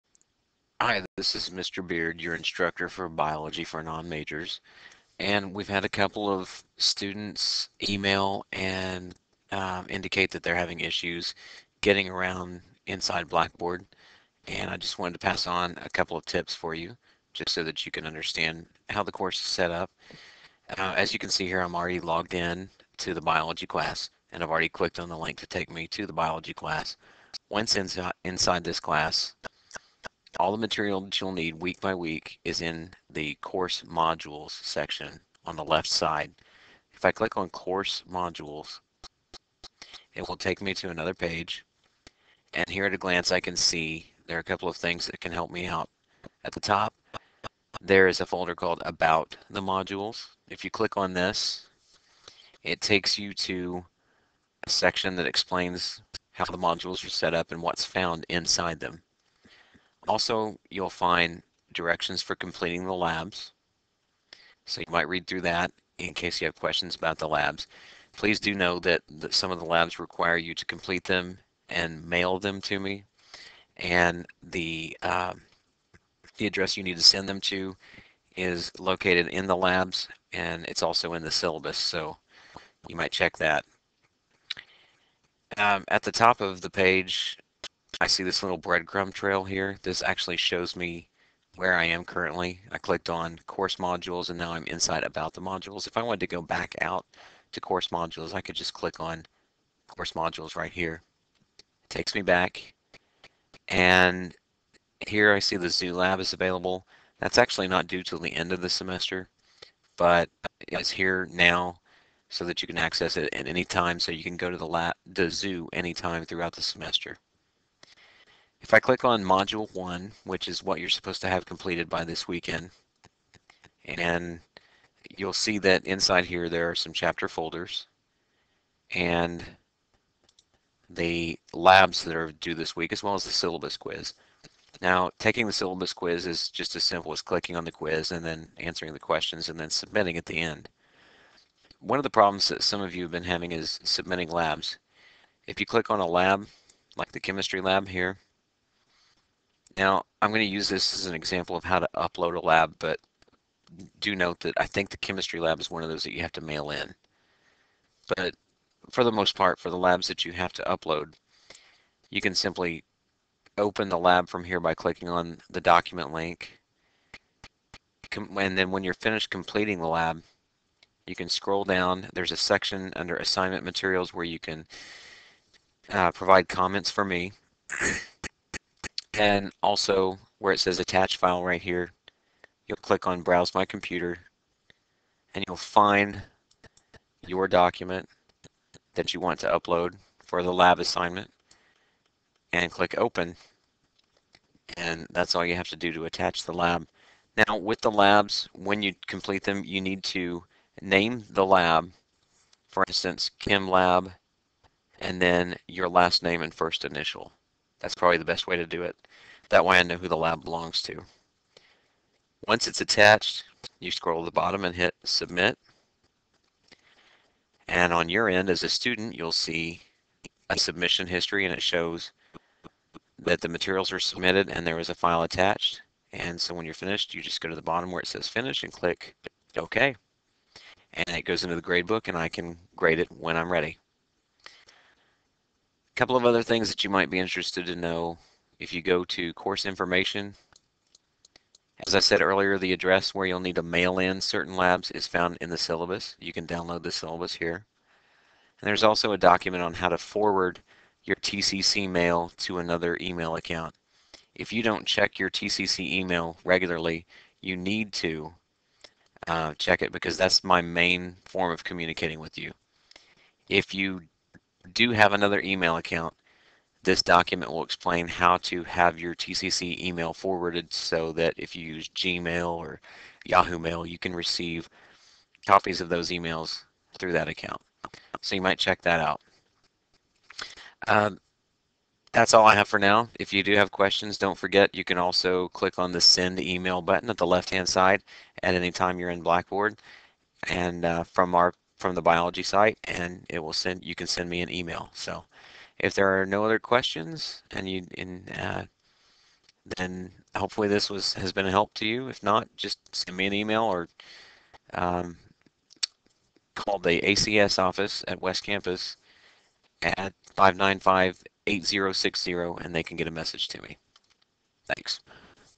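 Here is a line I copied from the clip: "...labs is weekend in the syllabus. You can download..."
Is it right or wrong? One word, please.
wrong.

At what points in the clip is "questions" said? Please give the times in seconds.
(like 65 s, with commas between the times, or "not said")
66 s, 138 s, 283 s, 296 s.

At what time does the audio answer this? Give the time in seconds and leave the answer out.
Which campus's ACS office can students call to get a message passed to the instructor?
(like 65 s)
308 s.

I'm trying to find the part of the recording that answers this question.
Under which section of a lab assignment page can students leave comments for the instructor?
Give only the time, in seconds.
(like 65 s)
173 s.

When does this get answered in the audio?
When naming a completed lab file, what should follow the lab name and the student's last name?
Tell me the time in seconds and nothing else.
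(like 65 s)
206 s.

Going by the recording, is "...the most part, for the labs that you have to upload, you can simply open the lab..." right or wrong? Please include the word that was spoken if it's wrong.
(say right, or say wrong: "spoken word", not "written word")
right.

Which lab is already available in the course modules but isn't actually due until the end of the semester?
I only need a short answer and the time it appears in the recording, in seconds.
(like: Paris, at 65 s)
Zoo Lab, at 105 s.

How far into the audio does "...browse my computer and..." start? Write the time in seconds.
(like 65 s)
183 s.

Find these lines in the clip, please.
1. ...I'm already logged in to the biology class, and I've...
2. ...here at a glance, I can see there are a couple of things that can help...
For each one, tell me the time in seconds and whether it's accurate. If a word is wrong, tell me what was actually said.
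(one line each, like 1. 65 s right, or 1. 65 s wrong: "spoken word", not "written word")
1. 21 s right
2. 42 s right.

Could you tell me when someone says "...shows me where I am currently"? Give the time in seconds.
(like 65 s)
90 s.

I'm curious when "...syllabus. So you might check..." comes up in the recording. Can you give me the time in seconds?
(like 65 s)
81 s.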